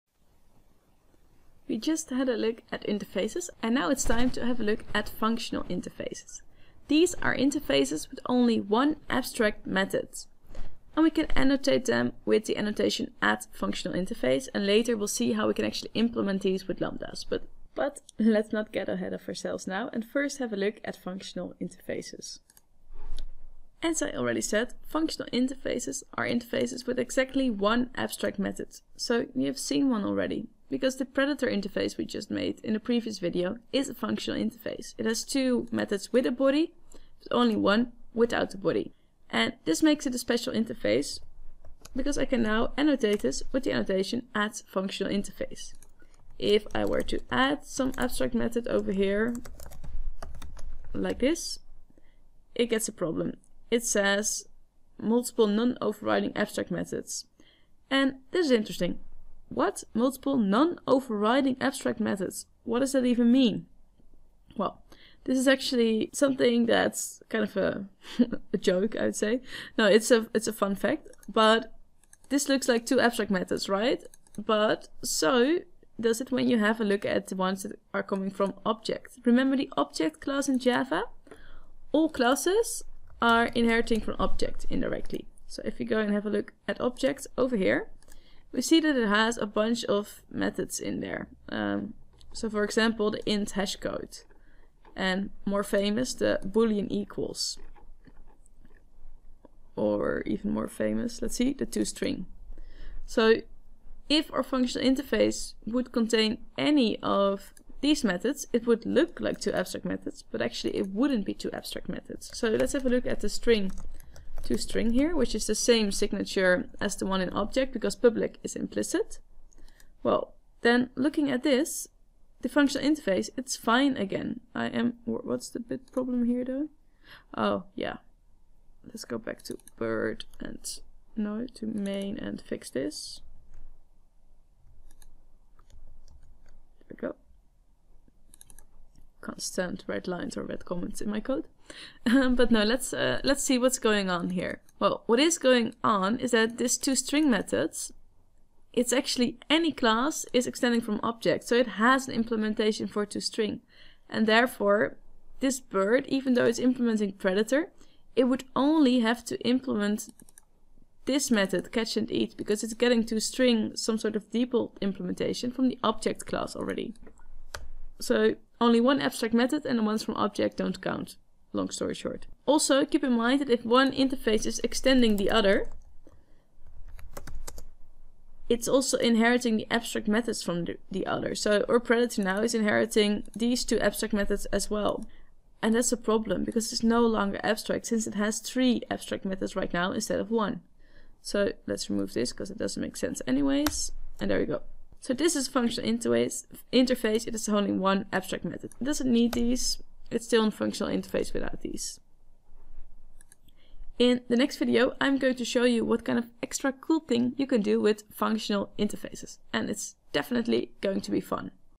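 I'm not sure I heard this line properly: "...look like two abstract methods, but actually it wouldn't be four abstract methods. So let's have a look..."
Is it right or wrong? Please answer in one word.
wrong.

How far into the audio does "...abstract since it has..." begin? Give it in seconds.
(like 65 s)
187 s.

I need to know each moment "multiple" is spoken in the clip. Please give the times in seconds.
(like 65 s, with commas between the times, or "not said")
54 s, 59 s.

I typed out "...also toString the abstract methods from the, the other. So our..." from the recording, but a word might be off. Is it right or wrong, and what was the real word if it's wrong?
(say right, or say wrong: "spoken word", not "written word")
wrong: "inheriting", not "toString".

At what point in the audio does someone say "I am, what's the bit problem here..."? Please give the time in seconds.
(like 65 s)
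124 s.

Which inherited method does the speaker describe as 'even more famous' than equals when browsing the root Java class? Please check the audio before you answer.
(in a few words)
toString.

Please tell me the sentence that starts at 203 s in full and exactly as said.
In the next video, I'm going to show you what kind of extra cool thing you can do with functional interfaces.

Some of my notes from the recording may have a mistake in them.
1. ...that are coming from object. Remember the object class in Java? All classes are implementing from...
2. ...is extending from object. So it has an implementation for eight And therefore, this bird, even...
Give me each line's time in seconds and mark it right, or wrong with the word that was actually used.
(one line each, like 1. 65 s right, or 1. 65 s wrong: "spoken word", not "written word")
1. 77 s wrong: "inheriting", not "implementing"
2. 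150 s wrong: "two", not "eight".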